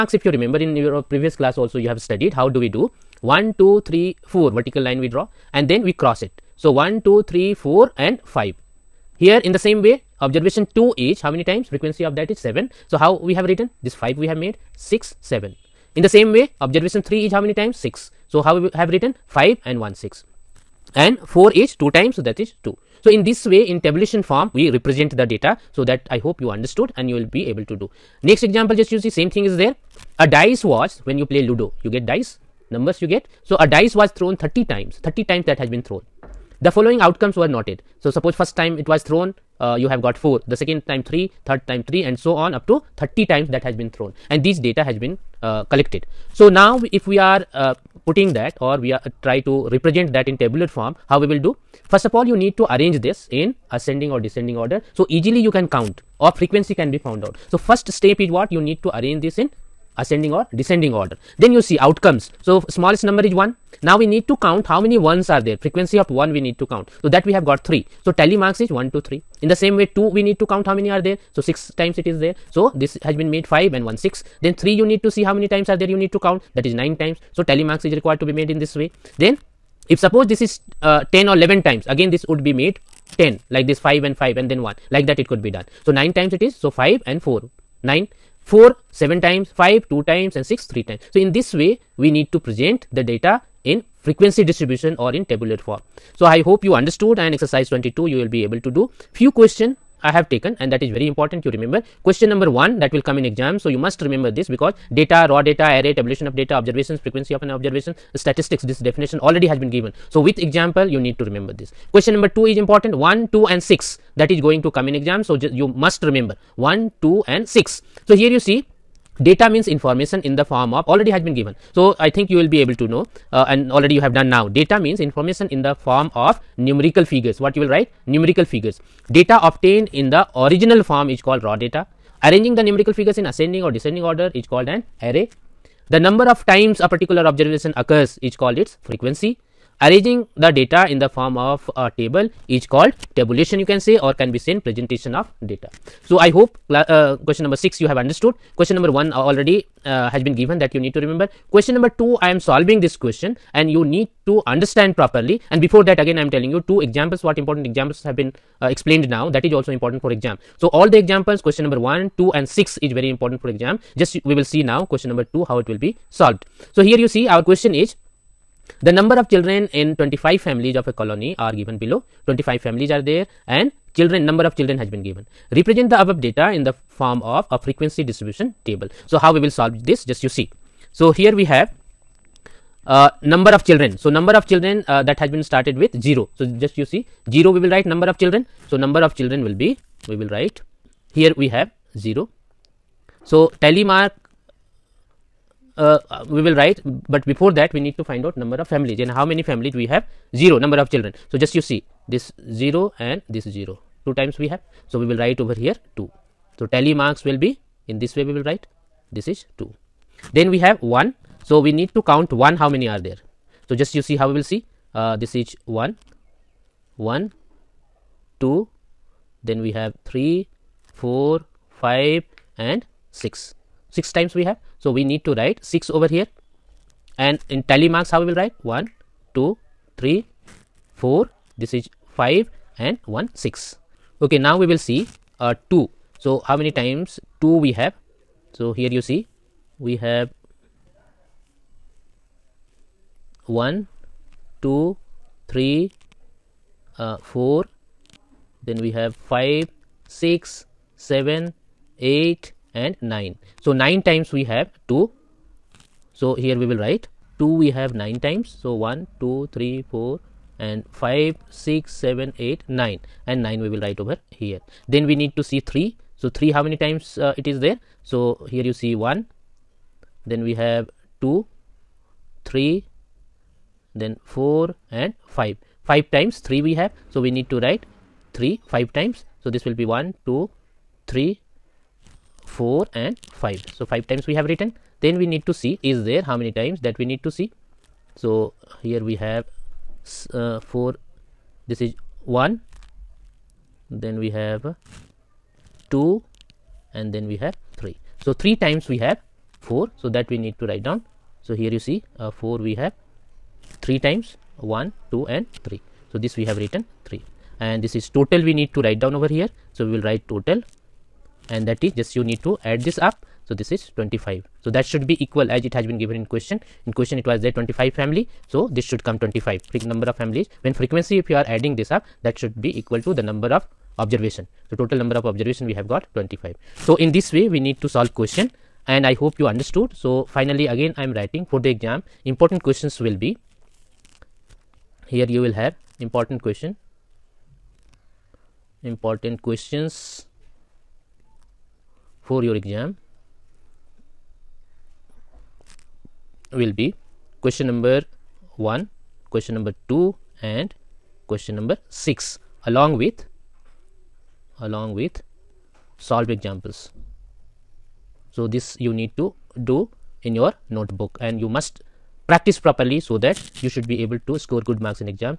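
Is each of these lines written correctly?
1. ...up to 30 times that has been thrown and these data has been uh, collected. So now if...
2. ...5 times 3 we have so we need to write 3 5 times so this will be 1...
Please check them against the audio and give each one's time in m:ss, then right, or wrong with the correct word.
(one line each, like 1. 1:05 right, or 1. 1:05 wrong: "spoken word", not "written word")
1. 0:42 right
2. 4:35 right.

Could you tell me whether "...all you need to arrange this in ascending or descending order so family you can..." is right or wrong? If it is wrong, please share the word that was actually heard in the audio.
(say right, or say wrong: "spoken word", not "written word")
wrong: "easily", not "family".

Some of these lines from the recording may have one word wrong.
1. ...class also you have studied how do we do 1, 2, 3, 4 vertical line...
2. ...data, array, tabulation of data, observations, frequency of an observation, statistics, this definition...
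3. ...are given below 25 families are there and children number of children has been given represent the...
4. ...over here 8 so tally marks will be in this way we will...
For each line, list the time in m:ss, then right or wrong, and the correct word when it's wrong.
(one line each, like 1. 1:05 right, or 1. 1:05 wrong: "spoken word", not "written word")
1. 0:01 right
2. 1:45 right
3. 2:51 right
4. 3:25 wrong: "2", not "8".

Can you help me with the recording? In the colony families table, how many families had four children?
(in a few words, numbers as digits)
3.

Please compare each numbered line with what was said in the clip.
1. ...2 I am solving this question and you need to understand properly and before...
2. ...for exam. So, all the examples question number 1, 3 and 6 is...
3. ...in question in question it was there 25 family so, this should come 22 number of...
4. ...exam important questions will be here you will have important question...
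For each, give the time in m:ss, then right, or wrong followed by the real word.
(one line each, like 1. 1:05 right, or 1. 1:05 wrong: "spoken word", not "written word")
1. 2:31 right
2. 2:40 wrong: "2", not "3"
3. 5:16 wrong: "25", not "22"
4. 5:31 right.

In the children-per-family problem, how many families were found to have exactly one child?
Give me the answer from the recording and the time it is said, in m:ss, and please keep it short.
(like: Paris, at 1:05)
6, at 3:43.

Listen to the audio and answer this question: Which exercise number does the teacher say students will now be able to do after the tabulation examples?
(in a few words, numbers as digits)
22.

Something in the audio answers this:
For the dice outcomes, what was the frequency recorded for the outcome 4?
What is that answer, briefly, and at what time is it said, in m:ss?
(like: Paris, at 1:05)
7, at 1:28.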